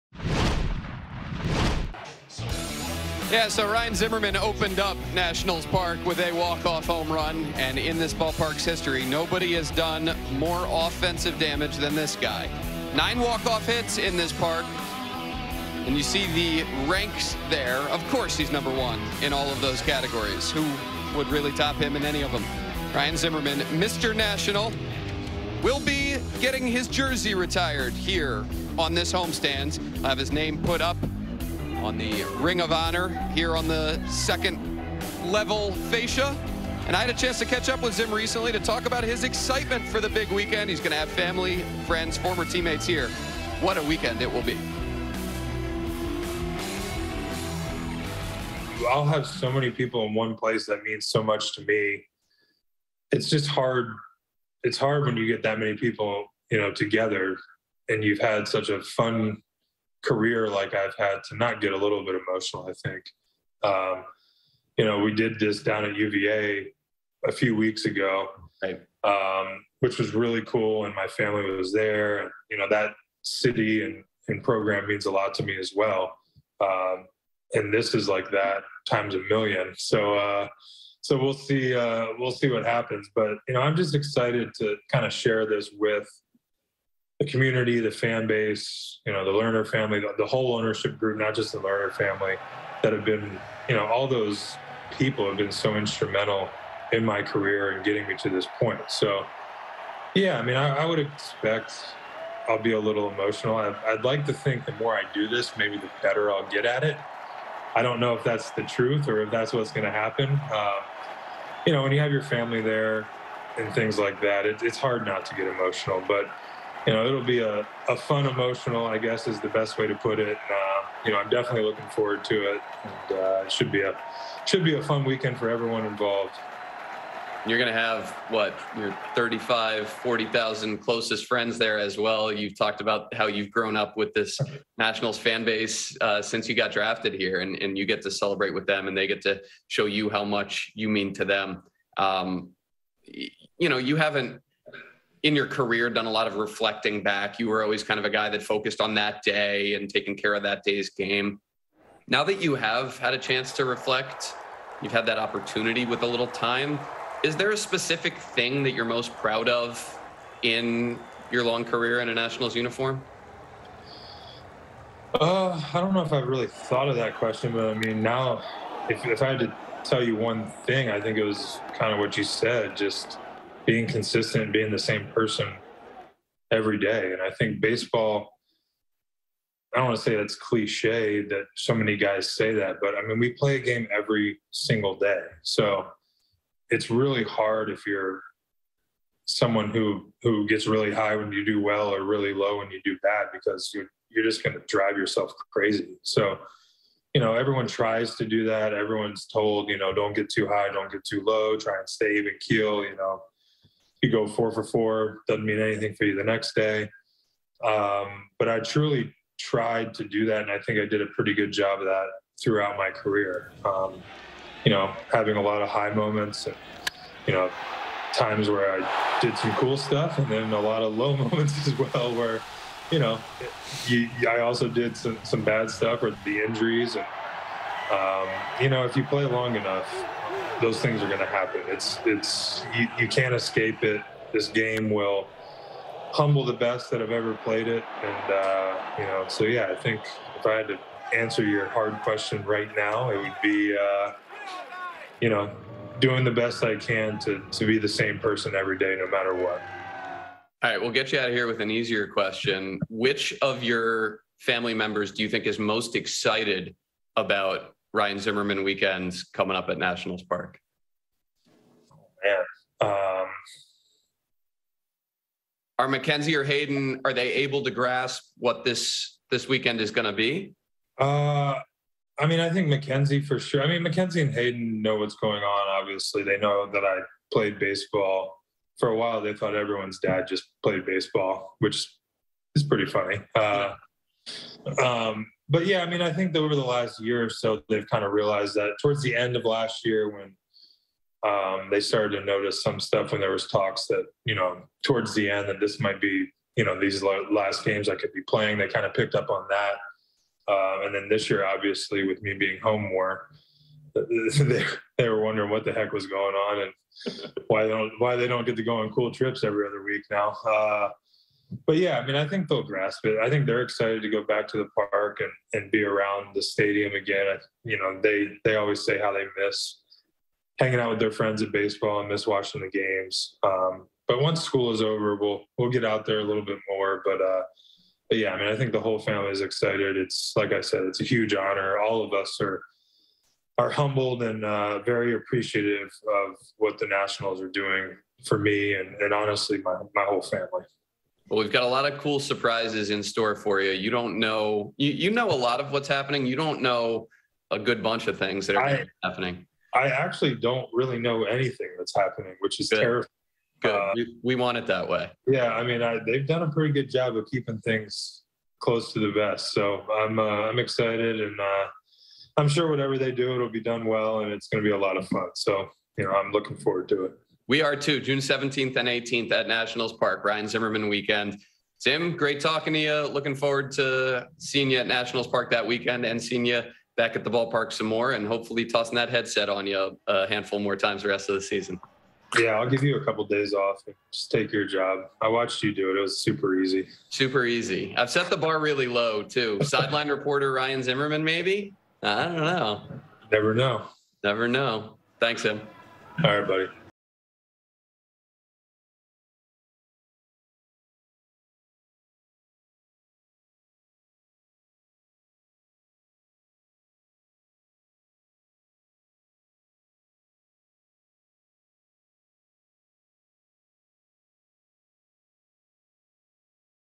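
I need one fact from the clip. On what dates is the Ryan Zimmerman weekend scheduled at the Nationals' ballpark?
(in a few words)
June 17th and 18th.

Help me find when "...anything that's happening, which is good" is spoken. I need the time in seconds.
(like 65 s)
351 s.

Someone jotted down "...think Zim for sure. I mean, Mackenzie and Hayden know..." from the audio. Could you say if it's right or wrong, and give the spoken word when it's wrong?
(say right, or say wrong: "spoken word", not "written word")
wrong: "Mackenzie", not "Zim".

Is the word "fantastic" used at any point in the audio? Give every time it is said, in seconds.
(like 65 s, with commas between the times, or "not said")
not said.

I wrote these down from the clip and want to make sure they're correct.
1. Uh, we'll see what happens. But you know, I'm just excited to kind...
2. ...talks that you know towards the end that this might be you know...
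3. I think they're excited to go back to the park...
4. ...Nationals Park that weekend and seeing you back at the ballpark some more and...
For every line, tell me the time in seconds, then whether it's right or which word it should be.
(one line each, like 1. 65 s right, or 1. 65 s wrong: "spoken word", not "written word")
1. 81 s right
2. 293 s right
3. 313 s right
4. 374 s right.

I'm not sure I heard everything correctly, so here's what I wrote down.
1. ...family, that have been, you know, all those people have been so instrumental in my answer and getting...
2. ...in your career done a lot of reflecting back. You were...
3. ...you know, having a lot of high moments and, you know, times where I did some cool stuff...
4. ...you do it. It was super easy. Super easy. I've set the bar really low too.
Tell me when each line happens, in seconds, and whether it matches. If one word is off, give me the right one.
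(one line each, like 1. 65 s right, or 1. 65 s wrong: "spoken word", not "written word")
1. 91 s wrong: "career", not "answer"
2. 145 s right
3. 214 s right
4. 385 s right.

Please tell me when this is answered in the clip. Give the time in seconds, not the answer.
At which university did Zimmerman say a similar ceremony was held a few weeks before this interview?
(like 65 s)
65 s.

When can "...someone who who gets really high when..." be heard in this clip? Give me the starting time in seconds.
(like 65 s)
189 s.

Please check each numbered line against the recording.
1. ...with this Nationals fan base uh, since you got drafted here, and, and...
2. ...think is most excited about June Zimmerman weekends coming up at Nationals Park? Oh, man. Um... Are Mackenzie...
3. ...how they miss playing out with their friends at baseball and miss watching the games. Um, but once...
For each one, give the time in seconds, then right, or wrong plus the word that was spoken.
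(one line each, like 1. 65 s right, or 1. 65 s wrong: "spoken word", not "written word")
1. 133 s right
2. 255 s wrong: "Ryan", not "June"
3. 318 s wrong: "hanging", not "playing".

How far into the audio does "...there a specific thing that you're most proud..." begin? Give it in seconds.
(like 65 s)
157 s.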